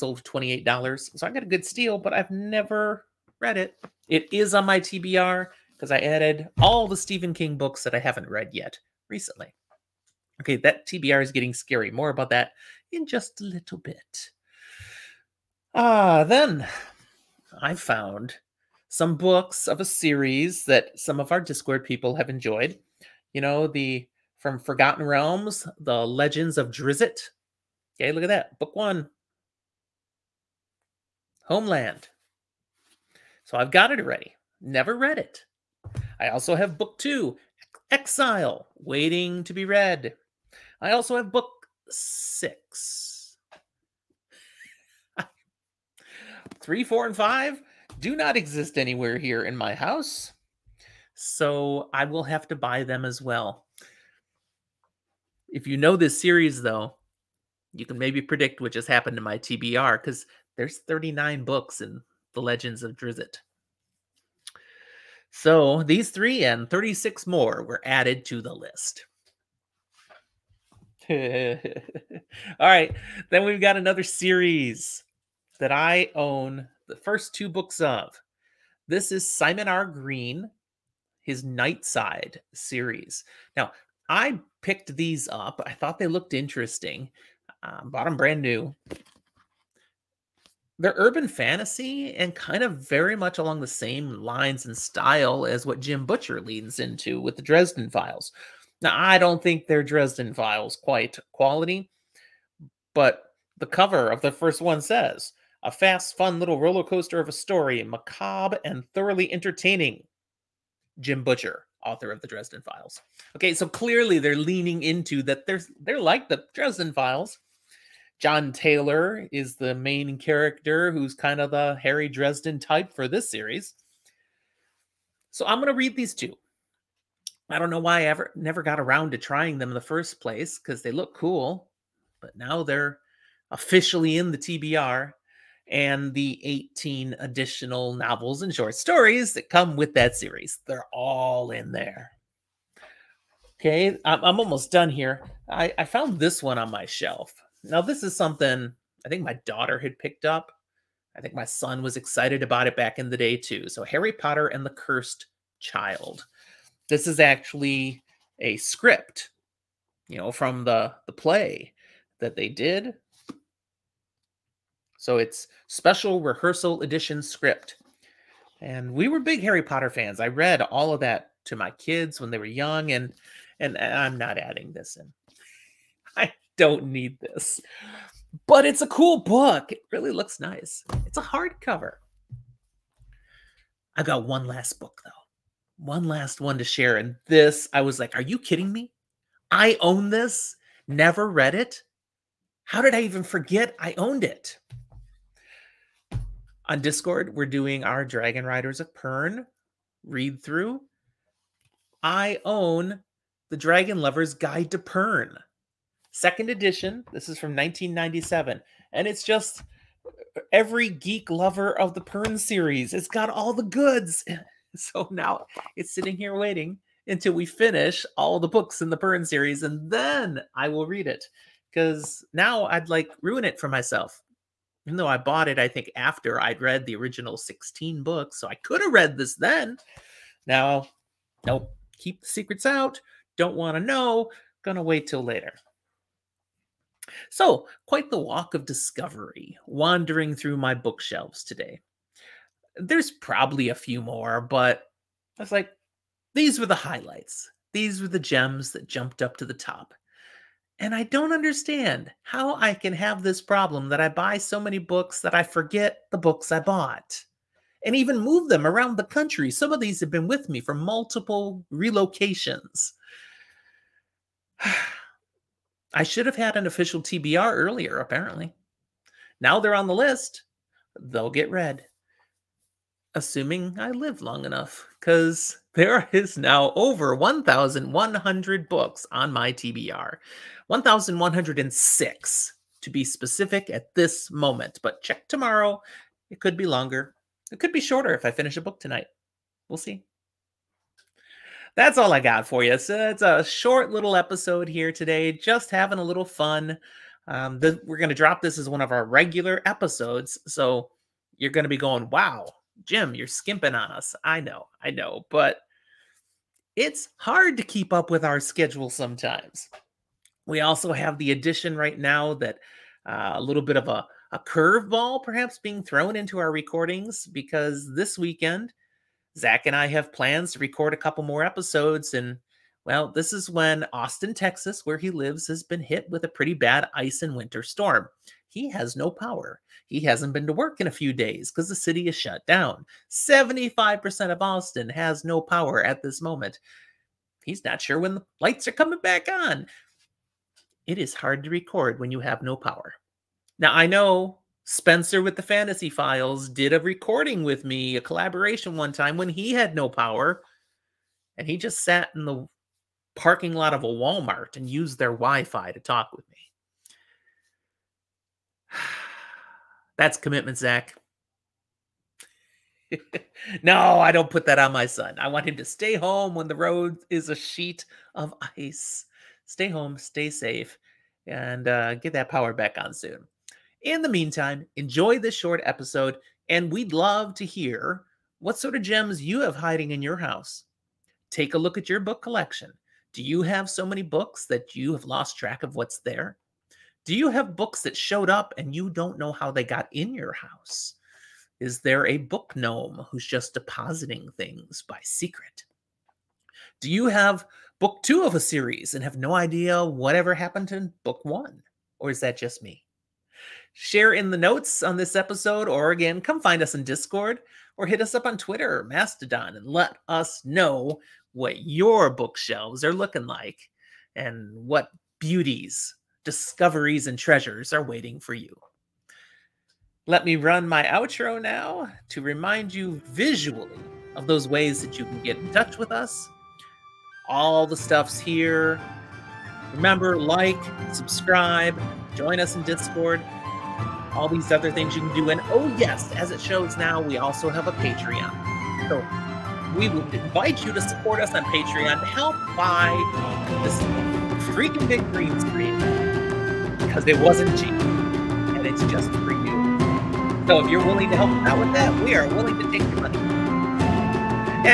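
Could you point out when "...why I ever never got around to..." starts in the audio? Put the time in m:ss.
2:07.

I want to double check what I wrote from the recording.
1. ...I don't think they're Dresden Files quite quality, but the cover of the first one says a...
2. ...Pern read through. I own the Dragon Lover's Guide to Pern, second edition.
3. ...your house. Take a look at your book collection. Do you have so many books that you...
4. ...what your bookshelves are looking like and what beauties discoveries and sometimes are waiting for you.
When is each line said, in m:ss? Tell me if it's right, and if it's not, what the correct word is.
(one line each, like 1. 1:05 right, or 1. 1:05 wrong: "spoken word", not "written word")
1. 1:38 right
2. 3:18 right
3. 6:20 right
4. 6:51 wrong: "treasures", not "sometimes".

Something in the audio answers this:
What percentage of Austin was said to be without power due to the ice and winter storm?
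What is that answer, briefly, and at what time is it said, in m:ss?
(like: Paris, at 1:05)
75%, at 5:33.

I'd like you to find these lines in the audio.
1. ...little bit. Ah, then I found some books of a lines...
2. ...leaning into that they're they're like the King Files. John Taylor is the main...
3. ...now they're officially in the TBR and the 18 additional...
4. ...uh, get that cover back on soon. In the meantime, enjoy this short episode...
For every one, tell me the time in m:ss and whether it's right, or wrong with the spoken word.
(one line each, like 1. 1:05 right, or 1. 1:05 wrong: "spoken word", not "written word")
1. 0:13 wrong: "series", not "lines"
2. 1:54 wrong: "Dresden", not "King"
3. 2:12 right
4. 6:11 wrong: "power", not "cover".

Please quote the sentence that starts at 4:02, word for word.
There's probably a few more, but I was like, these were the highlights.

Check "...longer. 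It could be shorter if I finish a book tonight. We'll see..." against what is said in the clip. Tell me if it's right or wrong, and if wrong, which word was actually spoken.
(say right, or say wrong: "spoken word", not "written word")
right.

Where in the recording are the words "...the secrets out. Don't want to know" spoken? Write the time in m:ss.
3:52.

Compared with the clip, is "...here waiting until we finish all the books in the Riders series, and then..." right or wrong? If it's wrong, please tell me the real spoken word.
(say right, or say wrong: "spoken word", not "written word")
wrong: "Pern", not "Riders".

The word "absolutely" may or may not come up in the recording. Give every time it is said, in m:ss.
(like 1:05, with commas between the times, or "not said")
not said.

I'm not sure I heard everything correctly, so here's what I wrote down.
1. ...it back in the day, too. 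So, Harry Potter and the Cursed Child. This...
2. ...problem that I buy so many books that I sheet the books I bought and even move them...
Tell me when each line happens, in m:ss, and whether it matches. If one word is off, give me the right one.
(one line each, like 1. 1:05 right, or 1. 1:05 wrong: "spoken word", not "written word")
1. 2:32 right
2. 4:13 wrong: "forget", not "sheet".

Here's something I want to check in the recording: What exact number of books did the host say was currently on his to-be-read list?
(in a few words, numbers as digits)
1,106.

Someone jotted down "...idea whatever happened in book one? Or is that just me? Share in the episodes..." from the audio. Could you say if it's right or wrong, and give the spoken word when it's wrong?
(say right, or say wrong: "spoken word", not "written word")
wrong: "notes", not "episodes".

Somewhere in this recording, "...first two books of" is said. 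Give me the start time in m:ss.
1:16.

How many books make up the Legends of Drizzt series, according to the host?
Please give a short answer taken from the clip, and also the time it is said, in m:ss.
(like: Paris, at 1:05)
39, at 1:00.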